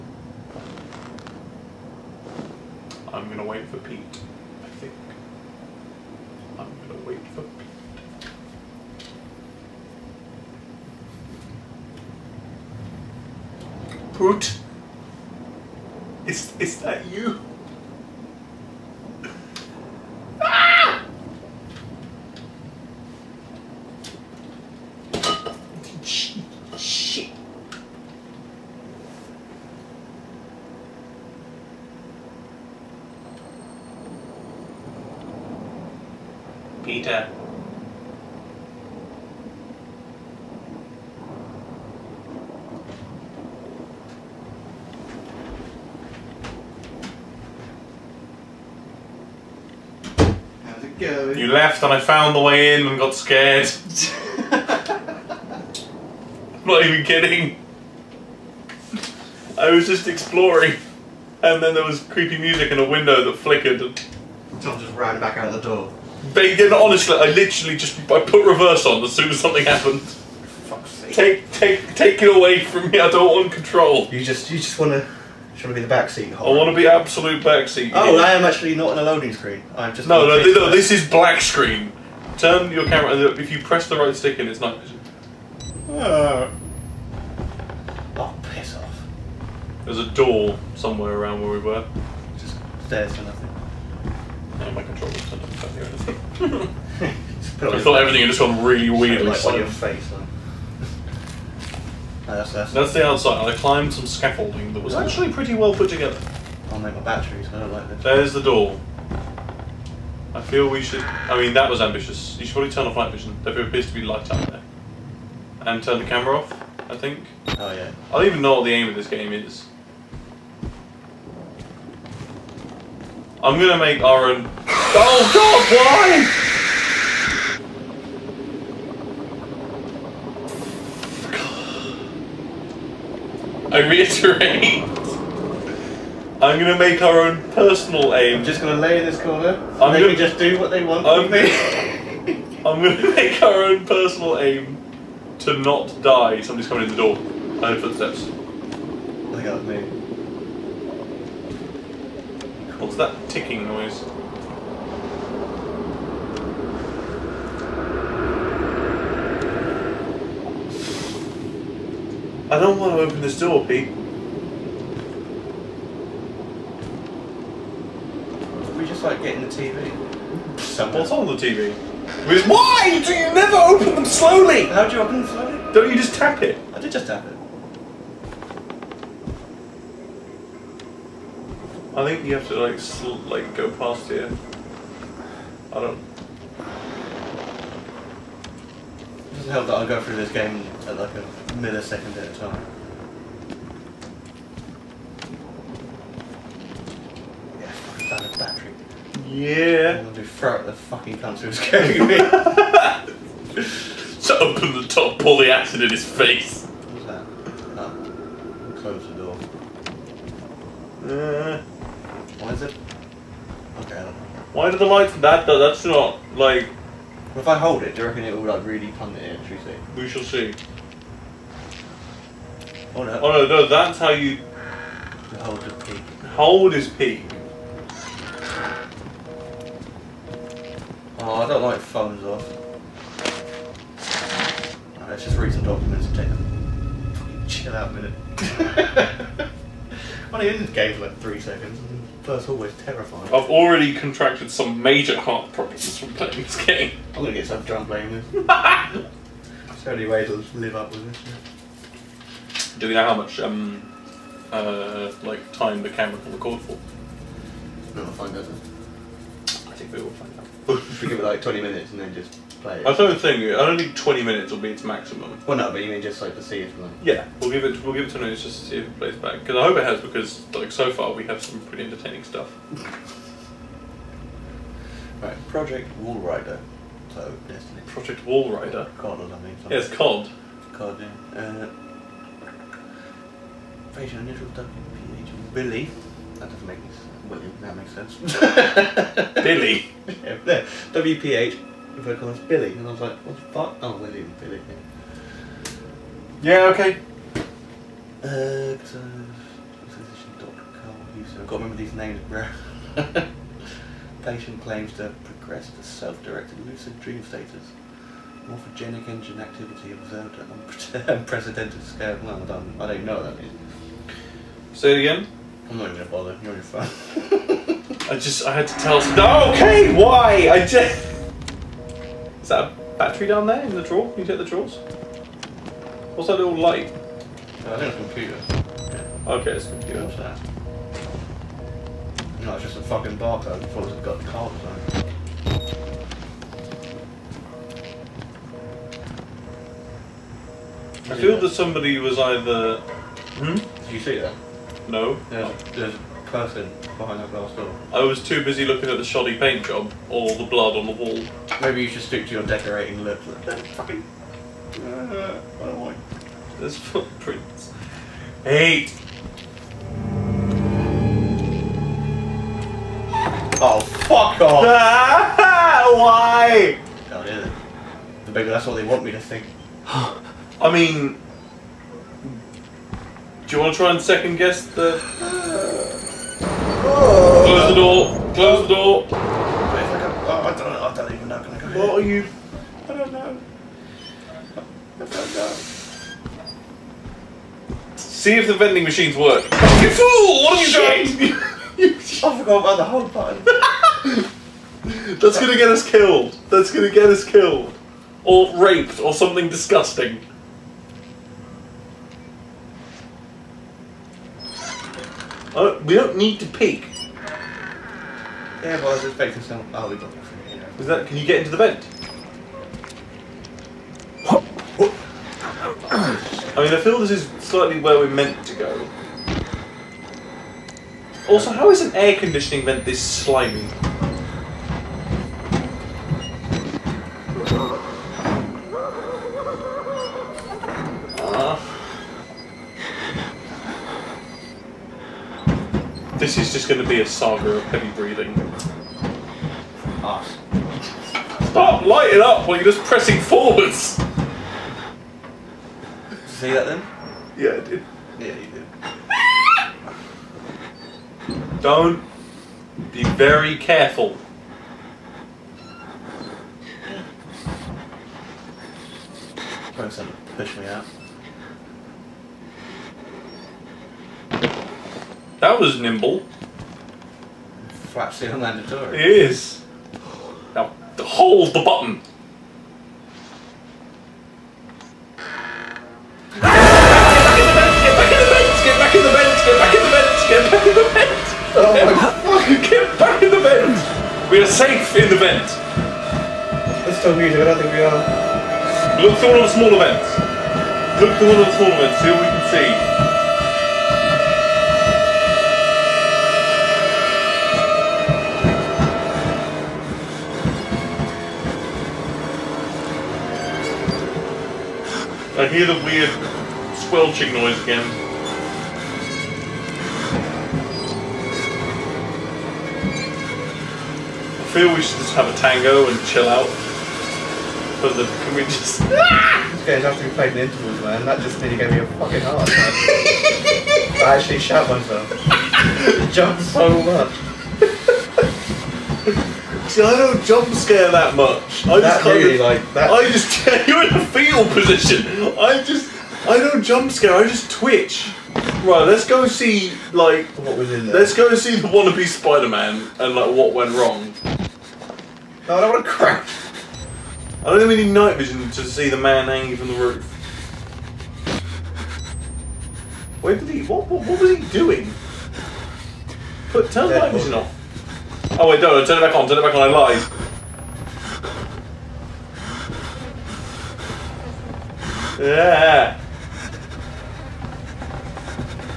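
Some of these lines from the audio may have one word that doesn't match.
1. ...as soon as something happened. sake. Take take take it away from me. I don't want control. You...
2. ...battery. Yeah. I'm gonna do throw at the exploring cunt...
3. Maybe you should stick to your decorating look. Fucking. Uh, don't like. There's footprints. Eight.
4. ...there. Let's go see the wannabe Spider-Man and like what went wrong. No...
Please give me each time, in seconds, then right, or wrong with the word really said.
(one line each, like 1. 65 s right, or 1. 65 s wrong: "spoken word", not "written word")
1. 69 s right
2. 198 s wrong: "fucking", not "exploring"
3. 351 s right
4. 540 s right.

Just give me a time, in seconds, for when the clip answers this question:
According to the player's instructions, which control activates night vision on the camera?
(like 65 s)
83 s.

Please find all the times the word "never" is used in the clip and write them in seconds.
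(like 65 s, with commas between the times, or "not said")
173 s.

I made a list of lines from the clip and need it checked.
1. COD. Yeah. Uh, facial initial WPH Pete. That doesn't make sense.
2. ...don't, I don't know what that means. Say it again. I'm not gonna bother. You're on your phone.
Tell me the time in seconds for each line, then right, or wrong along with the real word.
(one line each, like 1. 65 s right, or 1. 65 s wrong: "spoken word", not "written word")
1. 280 s wrong: "Billy", not "Pete"
2. 312 s right.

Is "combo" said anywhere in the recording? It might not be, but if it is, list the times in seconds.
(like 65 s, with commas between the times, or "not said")
not said.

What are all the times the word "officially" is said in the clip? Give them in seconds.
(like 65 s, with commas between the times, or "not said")
not said.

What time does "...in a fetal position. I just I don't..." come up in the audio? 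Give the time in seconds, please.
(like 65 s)
533 s.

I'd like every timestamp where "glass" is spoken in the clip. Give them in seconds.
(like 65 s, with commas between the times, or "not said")
347 s.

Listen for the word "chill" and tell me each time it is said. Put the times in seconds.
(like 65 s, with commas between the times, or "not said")
237 s, 516 s.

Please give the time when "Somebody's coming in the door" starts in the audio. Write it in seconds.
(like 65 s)
146 s.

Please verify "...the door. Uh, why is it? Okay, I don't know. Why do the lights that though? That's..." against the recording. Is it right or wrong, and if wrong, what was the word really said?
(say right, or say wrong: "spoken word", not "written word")
right.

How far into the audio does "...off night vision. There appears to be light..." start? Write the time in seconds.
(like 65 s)
112 s.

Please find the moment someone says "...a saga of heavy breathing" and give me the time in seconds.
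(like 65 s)
437 s.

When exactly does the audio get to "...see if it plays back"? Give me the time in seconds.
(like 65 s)
268 s.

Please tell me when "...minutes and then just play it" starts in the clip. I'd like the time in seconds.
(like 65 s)
261 s.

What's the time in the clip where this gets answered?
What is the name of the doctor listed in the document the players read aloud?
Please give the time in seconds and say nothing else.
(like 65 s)
300 s.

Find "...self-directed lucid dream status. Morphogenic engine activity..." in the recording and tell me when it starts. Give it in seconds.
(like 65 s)
305 s.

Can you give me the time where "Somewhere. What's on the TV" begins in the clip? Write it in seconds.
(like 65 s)
170 s.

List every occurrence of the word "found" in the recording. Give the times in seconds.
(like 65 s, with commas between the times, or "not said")
51 s.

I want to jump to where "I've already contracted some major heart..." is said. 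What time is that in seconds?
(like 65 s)
243 s.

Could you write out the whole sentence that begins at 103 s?
I climbed some scaffolding that was actually pretty well put together.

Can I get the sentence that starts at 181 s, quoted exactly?
I think you have to like like go past here.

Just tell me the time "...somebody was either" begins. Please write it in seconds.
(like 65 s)
341 s.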